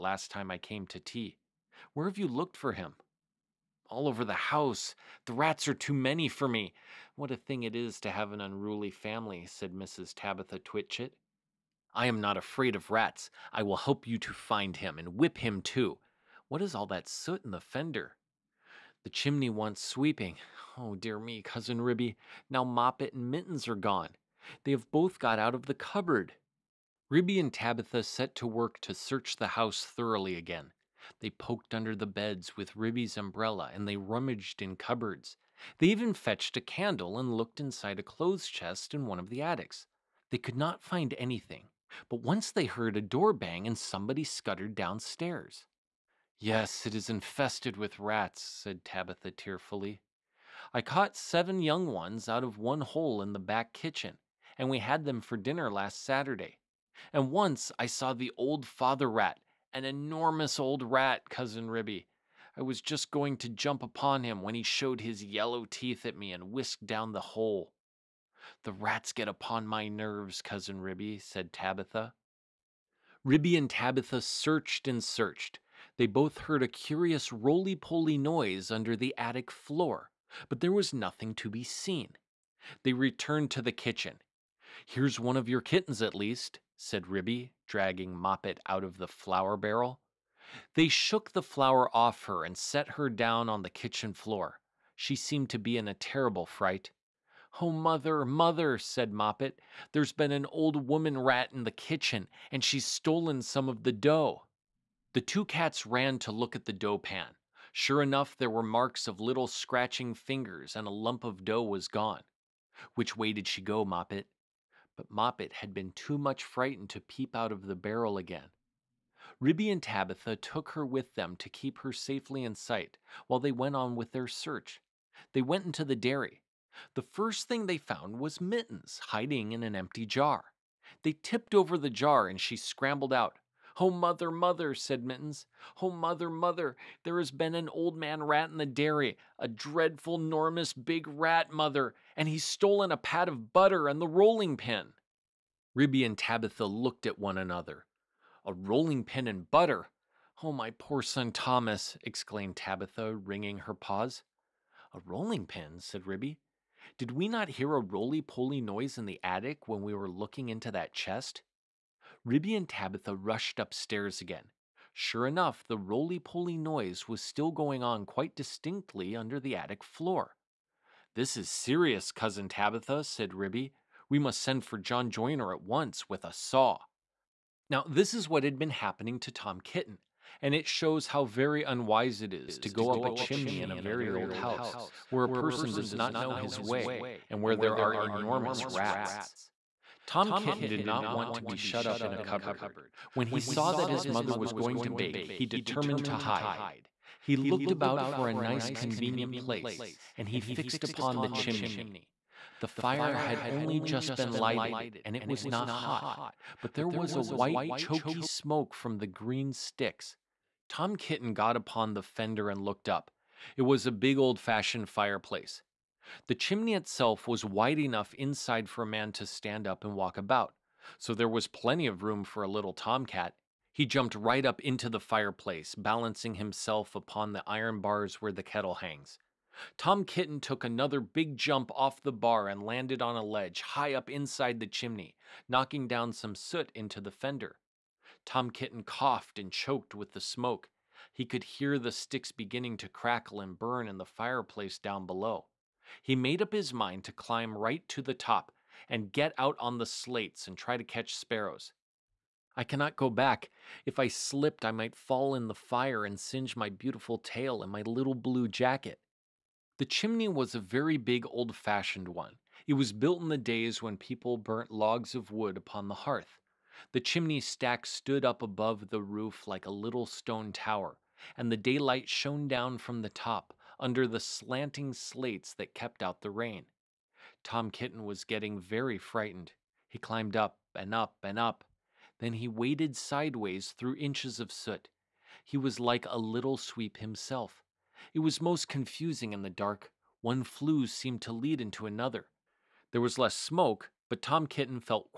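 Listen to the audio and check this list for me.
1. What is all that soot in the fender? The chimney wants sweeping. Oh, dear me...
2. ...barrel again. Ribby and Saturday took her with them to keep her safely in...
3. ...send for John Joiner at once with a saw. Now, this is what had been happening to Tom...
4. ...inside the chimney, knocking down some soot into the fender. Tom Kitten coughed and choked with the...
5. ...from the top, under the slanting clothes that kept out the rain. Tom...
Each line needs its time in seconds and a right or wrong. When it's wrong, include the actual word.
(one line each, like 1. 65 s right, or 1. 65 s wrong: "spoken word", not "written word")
1. 16 s right
2. 117 s wrong: "Tabitha", not "Saturday"
3. 174 s right
4. 234 s right
5. 272 s wrong: "slates", not "clothes".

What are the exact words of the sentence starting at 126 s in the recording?
The first thing they found was Mittens hiding in an empty jar.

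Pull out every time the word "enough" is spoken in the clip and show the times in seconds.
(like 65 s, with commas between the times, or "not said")
108 s, 165 s, 217 s.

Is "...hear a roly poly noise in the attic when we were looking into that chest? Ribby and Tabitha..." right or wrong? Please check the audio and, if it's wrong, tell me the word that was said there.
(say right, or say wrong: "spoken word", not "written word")
right.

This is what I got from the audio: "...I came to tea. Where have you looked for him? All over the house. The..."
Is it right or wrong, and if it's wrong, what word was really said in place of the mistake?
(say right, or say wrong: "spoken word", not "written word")
right.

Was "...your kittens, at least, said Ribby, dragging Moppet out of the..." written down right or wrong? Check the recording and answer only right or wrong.
right.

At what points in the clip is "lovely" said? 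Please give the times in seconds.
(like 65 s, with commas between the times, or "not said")
not said.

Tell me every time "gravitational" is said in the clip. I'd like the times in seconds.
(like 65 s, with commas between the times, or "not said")
not said.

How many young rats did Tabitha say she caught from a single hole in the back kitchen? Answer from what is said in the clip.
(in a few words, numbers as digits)
7.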